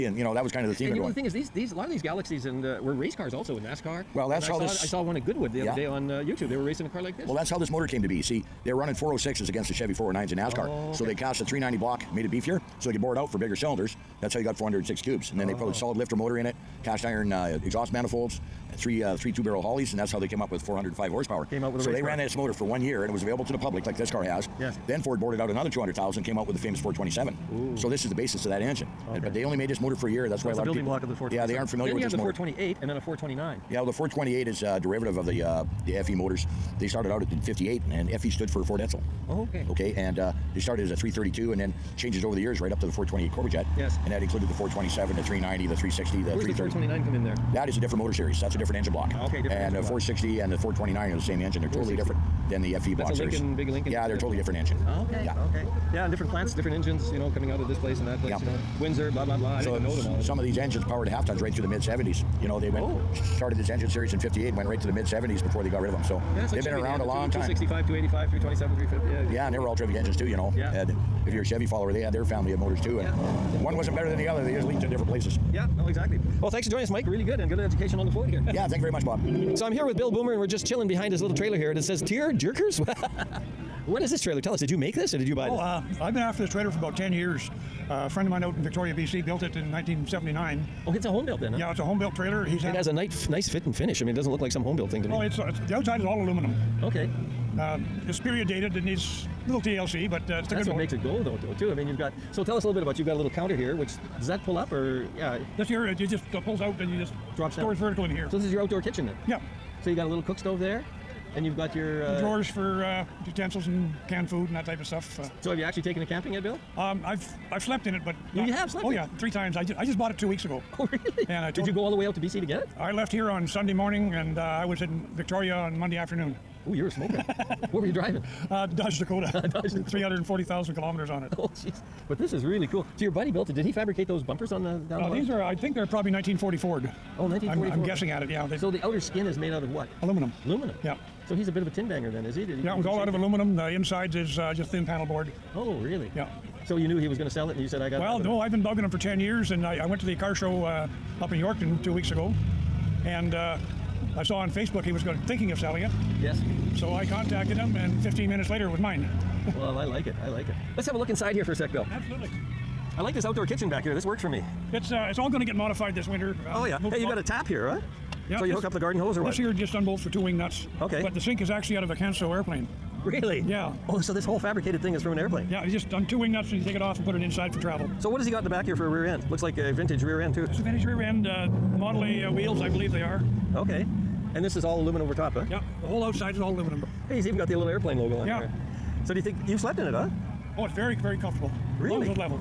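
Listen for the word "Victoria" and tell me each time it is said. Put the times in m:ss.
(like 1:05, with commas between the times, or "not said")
1:28, 2:05.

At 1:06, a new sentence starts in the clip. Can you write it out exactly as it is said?
So yeah, like they've been Chevy.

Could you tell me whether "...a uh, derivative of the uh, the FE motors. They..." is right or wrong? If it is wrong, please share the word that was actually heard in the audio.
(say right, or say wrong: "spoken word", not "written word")
right.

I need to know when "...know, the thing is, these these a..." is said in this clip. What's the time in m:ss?
0:00.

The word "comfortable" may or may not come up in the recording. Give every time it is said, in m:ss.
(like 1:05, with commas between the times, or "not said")
3:11.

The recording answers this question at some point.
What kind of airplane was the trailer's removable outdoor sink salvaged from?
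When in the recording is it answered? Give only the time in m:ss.
2:51.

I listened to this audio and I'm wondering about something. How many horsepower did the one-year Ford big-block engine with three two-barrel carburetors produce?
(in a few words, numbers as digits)
405.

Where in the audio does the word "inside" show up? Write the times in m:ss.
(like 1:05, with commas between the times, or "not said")
2:23, 2:41, 2:57.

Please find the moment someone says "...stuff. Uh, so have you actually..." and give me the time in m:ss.
1:54.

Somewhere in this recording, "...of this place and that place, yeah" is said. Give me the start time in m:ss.
0:57.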